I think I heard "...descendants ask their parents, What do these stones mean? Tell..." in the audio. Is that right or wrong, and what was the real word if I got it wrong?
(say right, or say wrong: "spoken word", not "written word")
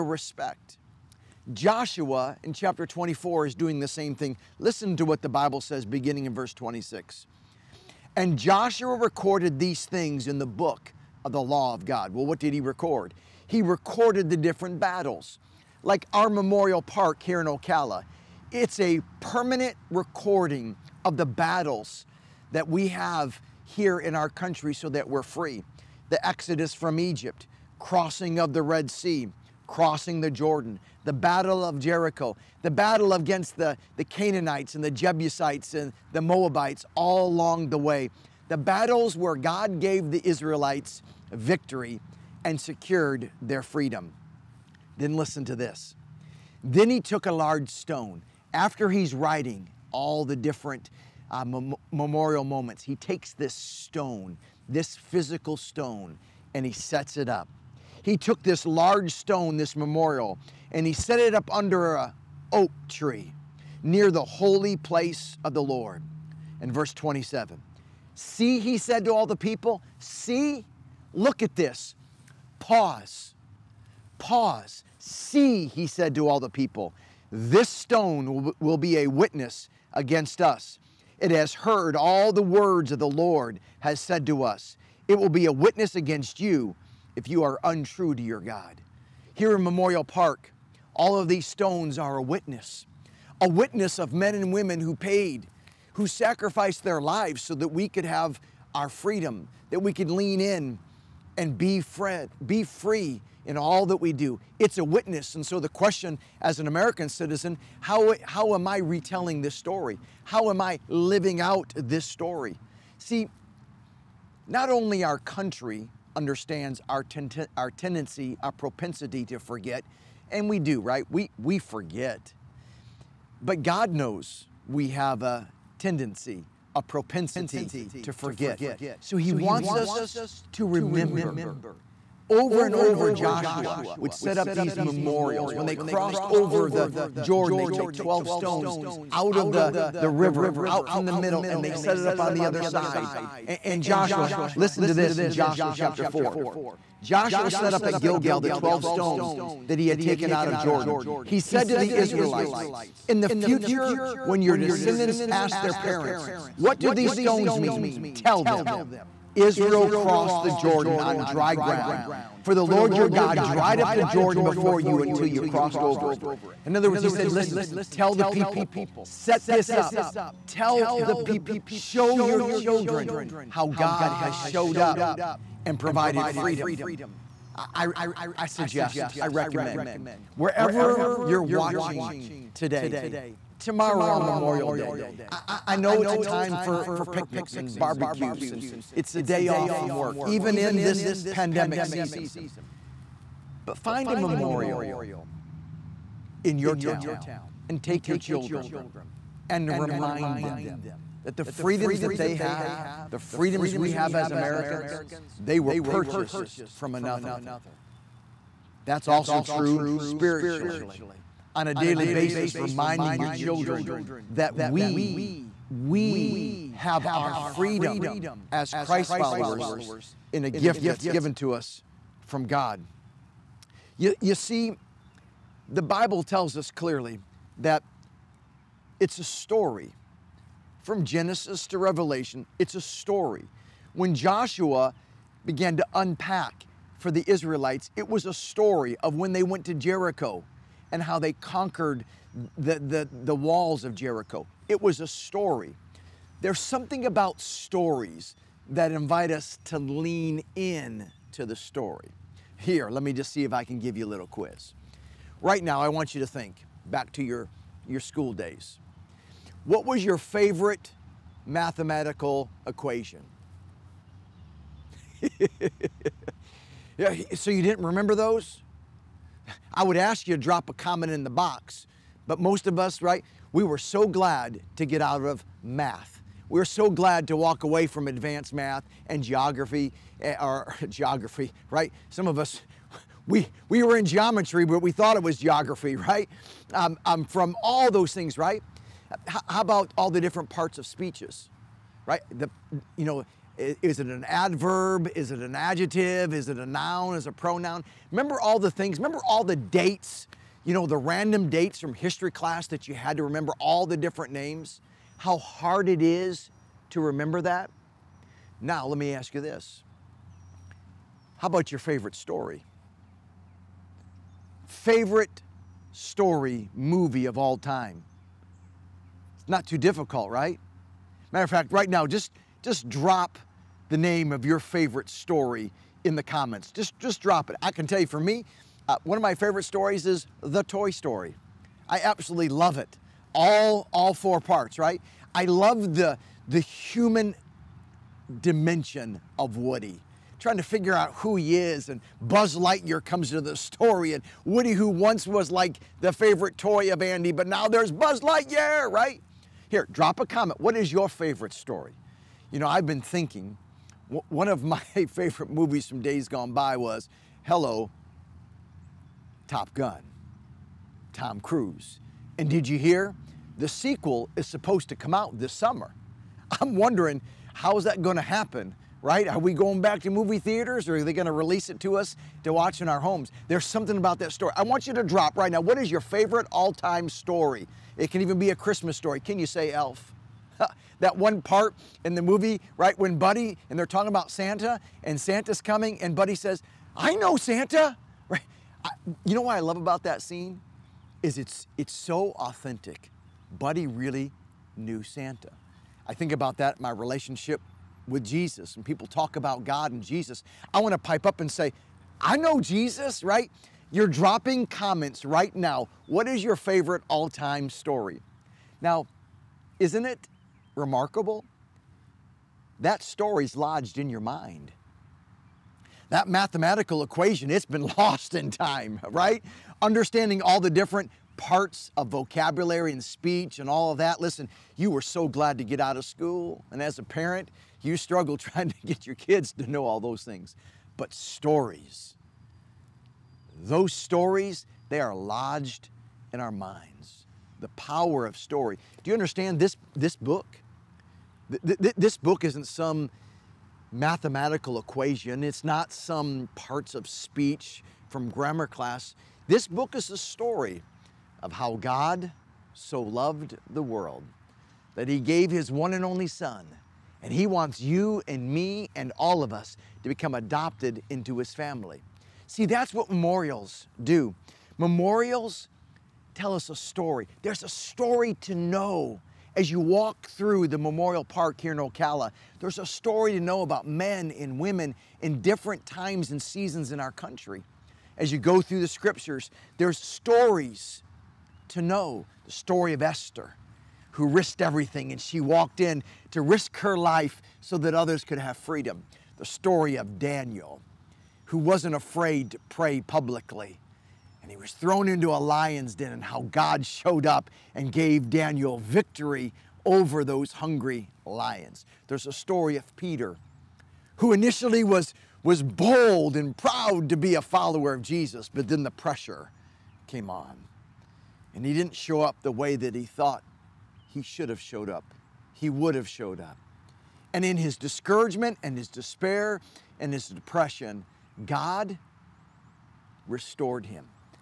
right.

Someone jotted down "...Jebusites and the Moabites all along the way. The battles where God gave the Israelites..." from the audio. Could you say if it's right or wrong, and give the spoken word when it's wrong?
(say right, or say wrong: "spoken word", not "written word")
right.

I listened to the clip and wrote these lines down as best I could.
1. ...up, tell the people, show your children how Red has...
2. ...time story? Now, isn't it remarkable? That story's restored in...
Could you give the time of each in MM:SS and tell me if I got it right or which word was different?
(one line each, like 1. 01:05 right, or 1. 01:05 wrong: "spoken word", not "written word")
1. 02:49 wrong: "God", not "Red"
2. 06:47 wrong: "lodged", not "restored".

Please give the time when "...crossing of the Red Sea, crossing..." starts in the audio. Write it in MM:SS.
00:27.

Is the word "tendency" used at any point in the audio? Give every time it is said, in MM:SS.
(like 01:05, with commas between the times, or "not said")
01:57, 02:05.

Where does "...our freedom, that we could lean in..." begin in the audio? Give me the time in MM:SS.
01:38.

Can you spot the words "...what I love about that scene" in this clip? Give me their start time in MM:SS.
06:29.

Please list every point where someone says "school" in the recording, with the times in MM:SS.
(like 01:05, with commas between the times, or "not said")
04:18, 07:06.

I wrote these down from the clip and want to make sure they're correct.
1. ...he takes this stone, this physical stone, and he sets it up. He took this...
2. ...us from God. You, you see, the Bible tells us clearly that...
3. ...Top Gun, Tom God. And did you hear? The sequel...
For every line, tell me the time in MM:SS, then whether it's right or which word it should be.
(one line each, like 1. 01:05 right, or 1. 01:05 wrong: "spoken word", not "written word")
1. 00:52 right
2. 03:41 right
3. 05:59 wrong: "Cruise", not "God".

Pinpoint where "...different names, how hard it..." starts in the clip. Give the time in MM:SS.
05:03.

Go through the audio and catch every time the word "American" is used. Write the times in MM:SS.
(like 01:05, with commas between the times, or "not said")
01:46, 03:24.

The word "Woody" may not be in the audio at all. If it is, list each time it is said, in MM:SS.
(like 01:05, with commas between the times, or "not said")
05:39, 05:44.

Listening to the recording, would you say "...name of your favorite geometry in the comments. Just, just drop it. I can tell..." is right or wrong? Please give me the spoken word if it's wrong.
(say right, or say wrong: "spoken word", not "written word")
wrong: "story", not "geometry".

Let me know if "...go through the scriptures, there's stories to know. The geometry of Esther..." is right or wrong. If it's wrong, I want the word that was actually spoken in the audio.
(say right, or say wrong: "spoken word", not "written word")
wrong: "story", not "geometry".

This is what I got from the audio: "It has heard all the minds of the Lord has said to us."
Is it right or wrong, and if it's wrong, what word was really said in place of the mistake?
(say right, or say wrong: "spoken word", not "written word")
wrong: "words", not "minds".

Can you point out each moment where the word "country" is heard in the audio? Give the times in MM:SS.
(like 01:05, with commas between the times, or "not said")
00:24, 01:55, 07:57.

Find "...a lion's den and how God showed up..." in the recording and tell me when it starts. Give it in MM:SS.
08:15.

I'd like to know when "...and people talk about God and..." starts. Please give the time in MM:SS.
06:38.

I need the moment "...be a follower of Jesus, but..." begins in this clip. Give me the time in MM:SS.
08:27.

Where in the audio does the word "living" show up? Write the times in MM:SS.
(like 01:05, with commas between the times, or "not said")
01:50.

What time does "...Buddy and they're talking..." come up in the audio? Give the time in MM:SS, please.
06:23.